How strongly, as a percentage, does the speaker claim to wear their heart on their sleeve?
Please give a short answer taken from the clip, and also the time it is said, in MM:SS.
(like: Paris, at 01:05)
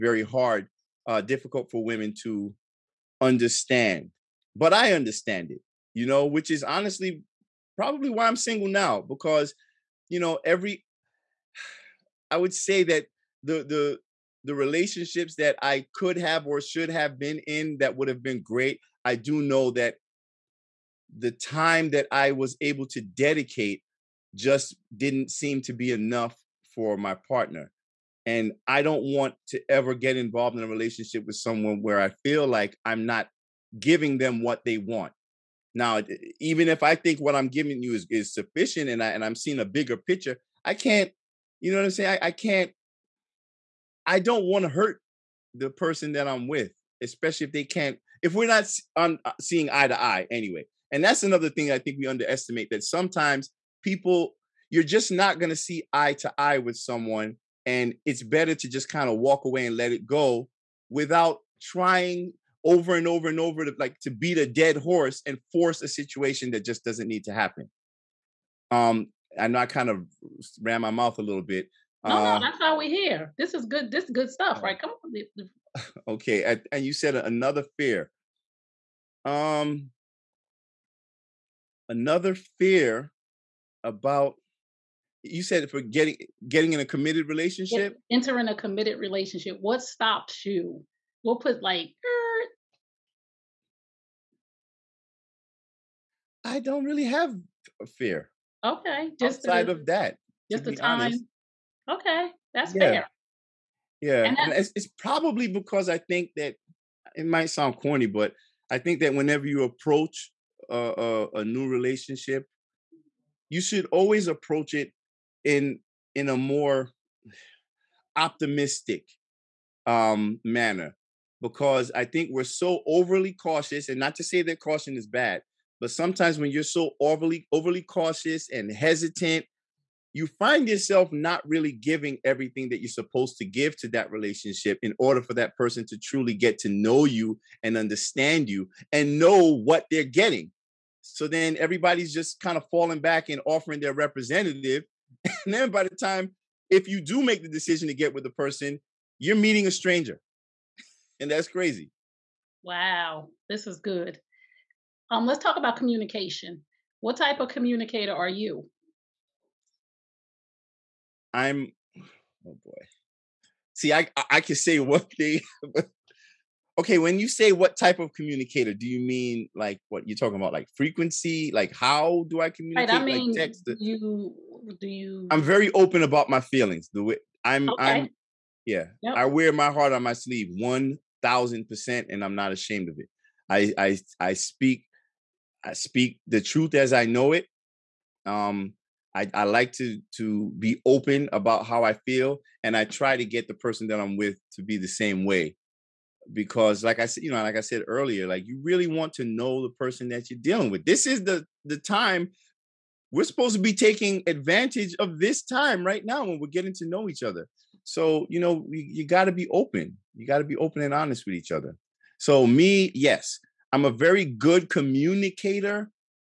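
1000 percent, at 03:00.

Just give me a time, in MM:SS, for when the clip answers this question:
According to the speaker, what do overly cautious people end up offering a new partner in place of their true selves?
02:23.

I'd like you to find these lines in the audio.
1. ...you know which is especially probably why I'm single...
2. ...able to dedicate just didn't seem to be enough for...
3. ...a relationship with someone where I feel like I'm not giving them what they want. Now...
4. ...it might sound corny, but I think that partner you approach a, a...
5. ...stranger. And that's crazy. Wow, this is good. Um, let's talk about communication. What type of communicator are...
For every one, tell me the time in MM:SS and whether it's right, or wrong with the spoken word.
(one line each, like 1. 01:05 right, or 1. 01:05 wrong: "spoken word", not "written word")
1. 00:05 wrong: "honestly", not "especially"
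2. 00:22 right
3. 00:30 right
4. 01:47 wrong: "whenever", not "partner"
5. 02:29 right.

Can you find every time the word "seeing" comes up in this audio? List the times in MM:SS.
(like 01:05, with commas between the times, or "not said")
00:39, 00:49.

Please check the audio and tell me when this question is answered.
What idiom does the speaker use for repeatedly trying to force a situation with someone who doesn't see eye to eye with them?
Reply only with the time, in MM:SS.
01:04.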